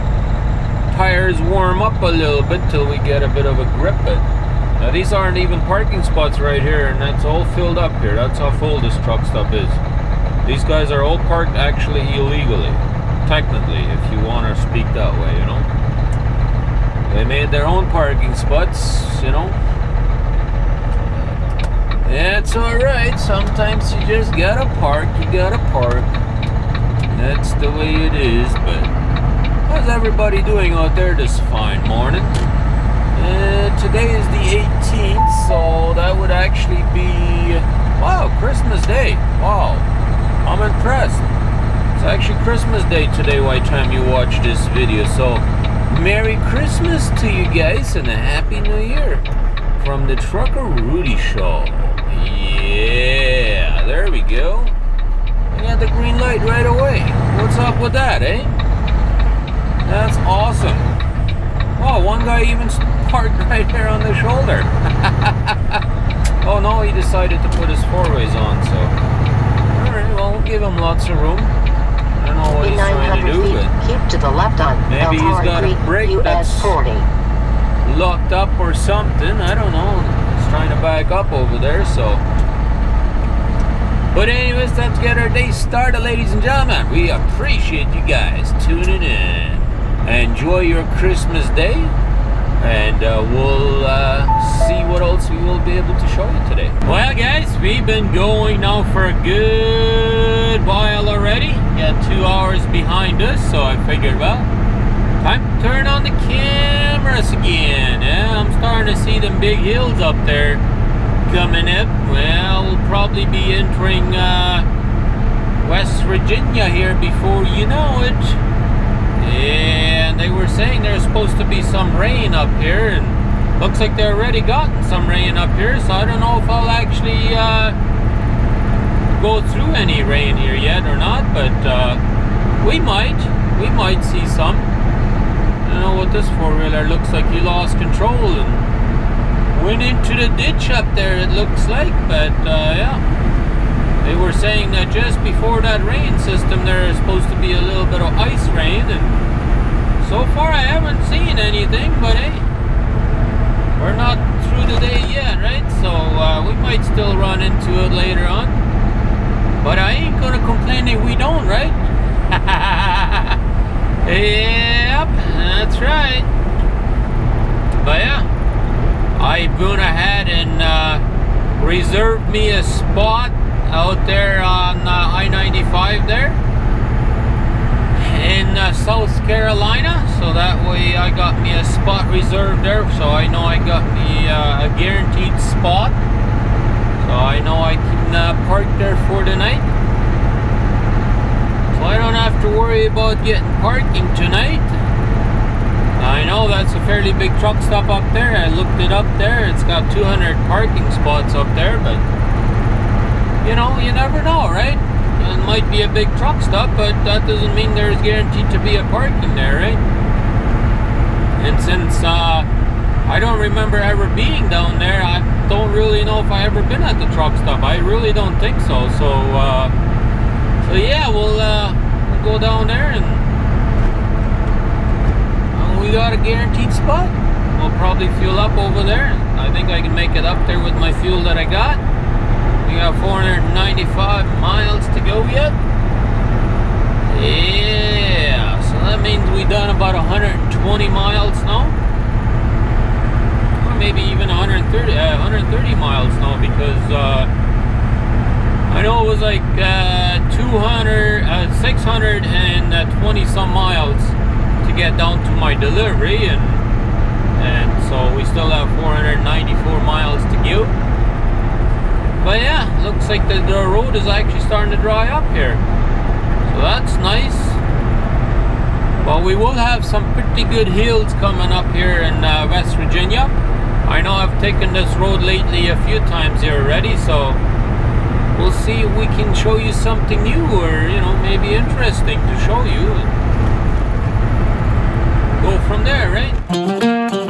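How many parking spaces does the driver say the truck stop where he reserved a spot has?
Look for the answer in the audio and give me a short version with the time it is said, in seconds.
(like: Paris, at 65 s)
200, at 199 s.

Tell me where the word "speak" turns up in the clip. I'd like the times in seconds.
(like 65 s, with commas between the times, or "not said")
14 s.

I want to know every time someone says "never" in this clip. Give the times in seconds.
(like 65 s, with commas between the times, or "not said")
203 s.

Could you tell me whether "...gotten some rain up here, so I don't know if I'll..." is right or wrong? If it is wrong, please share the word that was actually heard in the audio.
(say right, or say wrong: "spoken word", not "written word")
right.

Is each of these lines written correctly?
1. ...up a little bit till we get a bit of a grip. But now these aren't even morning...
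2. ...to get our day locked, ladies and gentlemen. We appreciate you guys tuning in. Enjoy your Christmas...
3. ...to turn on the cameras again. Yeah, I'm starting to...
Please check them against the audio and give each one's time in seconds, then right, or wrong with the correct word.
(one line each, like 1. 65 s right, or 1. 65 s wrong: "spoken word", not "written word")
1. 1 s wrong: "parking", not "morning"
2. 84 s wrong: "started", not "locked"
3. 105 s right.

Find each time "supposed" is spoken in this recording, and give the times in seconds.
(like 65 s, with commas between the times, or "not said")
121 s, 146 s.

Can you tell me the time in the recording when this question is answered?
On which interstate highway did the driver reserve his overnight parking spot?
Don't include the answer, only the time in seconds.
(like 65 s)
175 s.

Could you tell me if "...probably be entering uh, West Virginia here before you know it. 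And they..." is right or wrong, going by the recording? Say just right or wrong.
right.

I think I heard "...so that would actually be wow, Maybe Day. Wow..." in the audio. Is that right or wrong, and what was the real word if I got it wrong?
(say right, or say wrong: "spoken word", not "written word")
wrong: "Christmas", not "Maybe".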